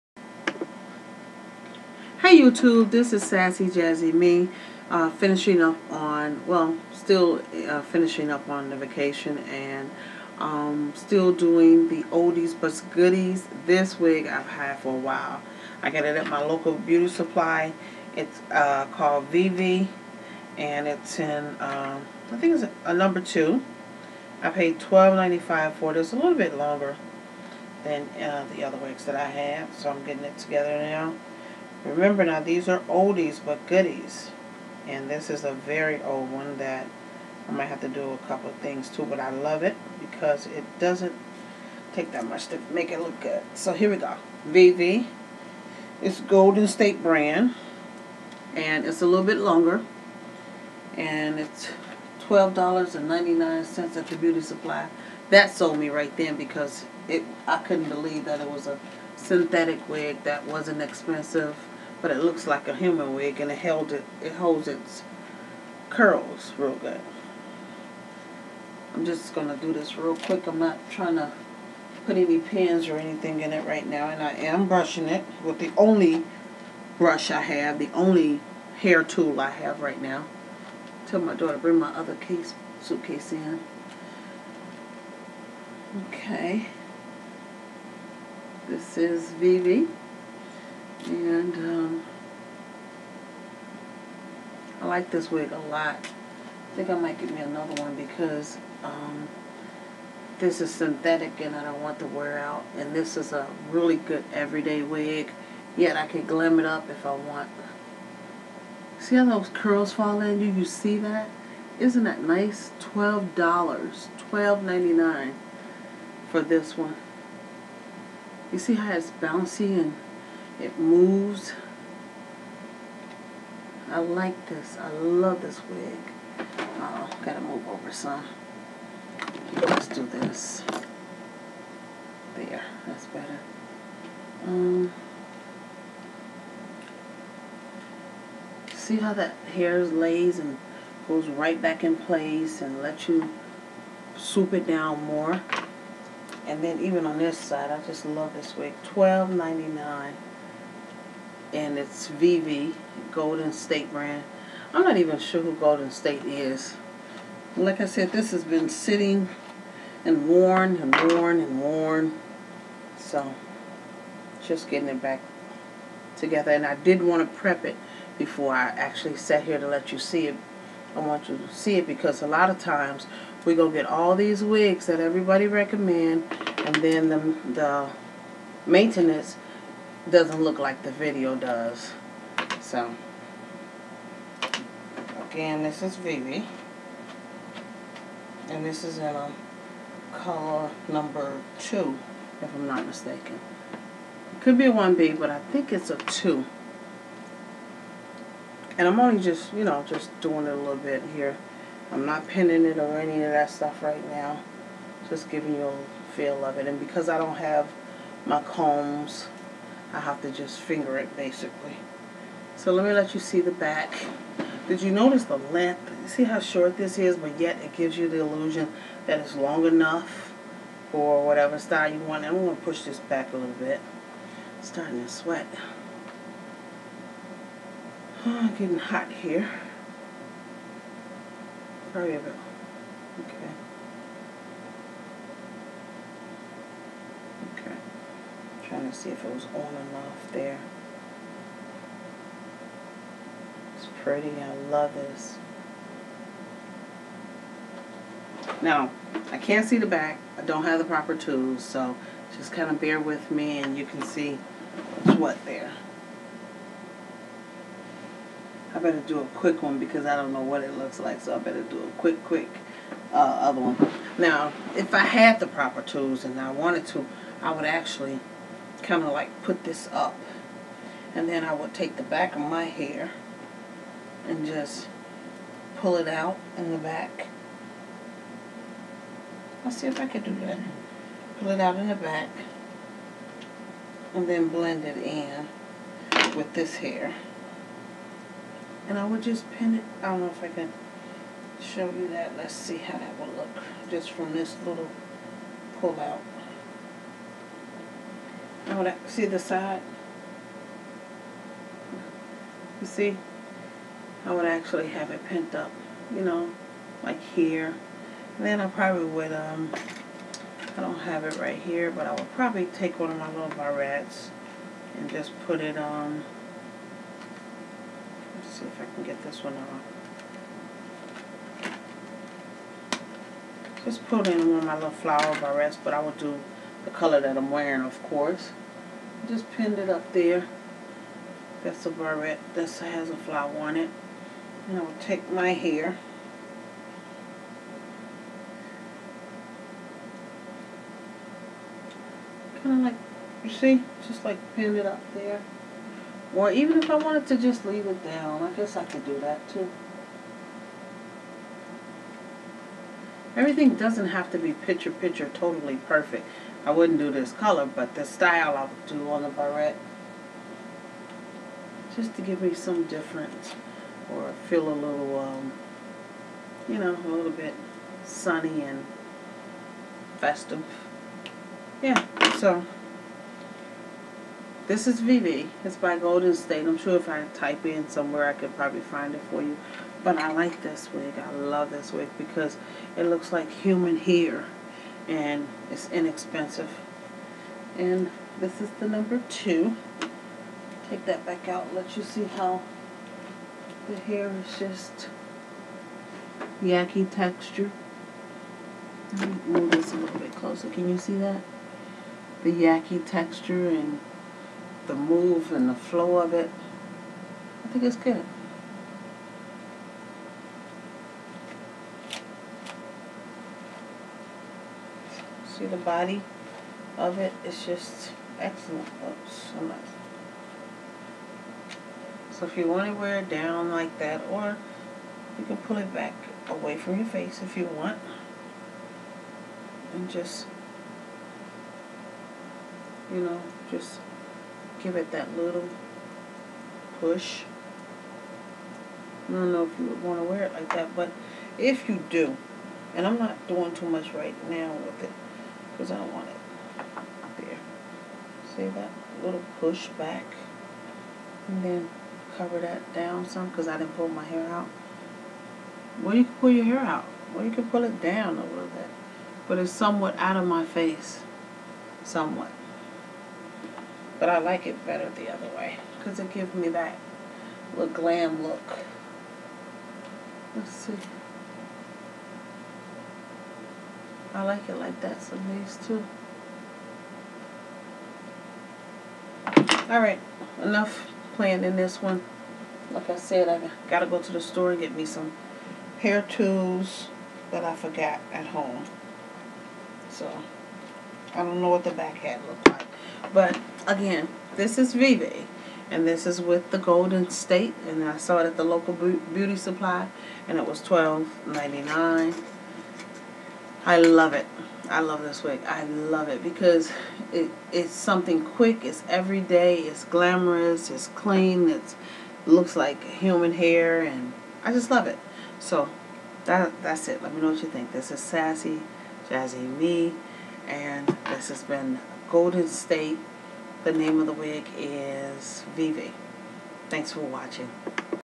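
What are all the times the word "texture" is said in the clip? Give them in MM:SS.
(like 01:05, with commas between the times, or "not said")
06:37, 06:43.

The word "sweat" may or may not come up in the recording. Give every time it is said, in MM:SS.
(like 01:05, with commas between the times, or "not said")
03:45.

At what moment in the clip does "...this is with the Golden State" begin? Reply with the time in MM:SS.
08:16.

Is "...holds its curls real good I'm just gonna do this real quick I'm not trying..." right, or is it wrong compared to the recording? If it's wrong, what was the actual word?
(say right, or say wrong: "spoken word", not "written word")
right.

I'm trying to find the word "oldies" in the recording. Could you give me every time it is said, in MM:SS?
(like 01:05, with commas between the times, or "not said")
00:12, 00:32.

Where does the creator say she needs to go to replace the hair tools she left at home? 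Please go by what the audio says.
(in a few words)
The store.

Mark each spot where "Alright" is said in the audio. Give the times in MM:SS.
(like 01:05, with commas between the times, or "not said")
07:59.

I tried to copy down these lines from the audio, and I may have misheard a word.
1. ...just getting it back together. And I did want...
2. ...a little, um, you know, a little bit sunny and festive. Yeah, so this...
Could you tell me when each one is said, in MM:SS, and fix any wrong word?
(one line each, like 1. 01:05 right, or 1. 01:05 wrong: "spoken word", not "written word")
1. 02:44 right
2. 06:04 right.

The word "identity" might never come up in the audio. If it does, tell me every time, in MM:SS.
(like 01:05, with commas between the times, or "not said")
not said.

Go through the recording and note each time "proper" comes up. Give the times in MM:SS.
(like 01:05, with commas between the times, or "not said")
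04:10, 04:25.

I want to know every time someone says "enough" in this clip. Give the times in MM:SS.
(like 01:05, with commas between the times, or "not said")
03:39, 08:00.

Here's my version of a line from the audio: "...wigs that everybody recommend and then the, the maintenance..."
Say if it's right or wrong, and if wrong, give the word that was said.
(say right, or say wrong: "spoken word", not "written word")
right.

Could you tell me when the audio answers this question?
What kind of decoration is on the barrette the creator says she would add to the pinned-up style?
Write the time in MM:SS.
05:33.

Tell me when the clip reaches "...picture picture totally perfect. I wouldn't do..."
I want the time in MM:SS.
05:54.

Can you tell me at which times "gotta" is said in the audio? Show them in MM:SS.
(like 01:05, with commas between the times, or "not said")
02:07, 08:03.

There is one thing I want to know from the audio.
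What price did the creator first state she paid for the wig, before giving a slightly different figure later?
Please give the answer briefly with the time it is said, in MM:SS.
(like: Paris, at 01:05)
$12.95, at 00:24.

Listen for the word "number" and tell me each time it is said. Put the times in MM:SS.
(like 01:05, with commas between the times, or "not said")
00:22, 03:10, 06:28.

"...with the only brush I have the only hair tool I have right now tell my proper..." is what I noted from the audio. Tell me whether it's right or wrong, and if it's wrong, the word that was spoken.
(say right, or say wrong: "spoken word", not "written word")
wrong: "daughter", not "proper".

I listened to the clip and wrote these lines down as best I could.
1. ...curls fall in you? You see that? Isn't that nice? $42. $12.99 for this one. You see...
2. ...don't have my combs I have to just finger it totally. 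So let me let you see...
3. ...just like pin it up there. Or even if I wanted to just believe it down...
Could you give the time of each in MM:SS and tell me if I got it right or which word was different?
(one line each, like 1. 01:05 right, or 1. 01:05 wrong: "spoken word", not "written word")
1. 01:49 wrong: "12", not "42"
2. 03:27 wrong: "basically", not "totally"
3. 05:44 wrong: "leave", not "believe".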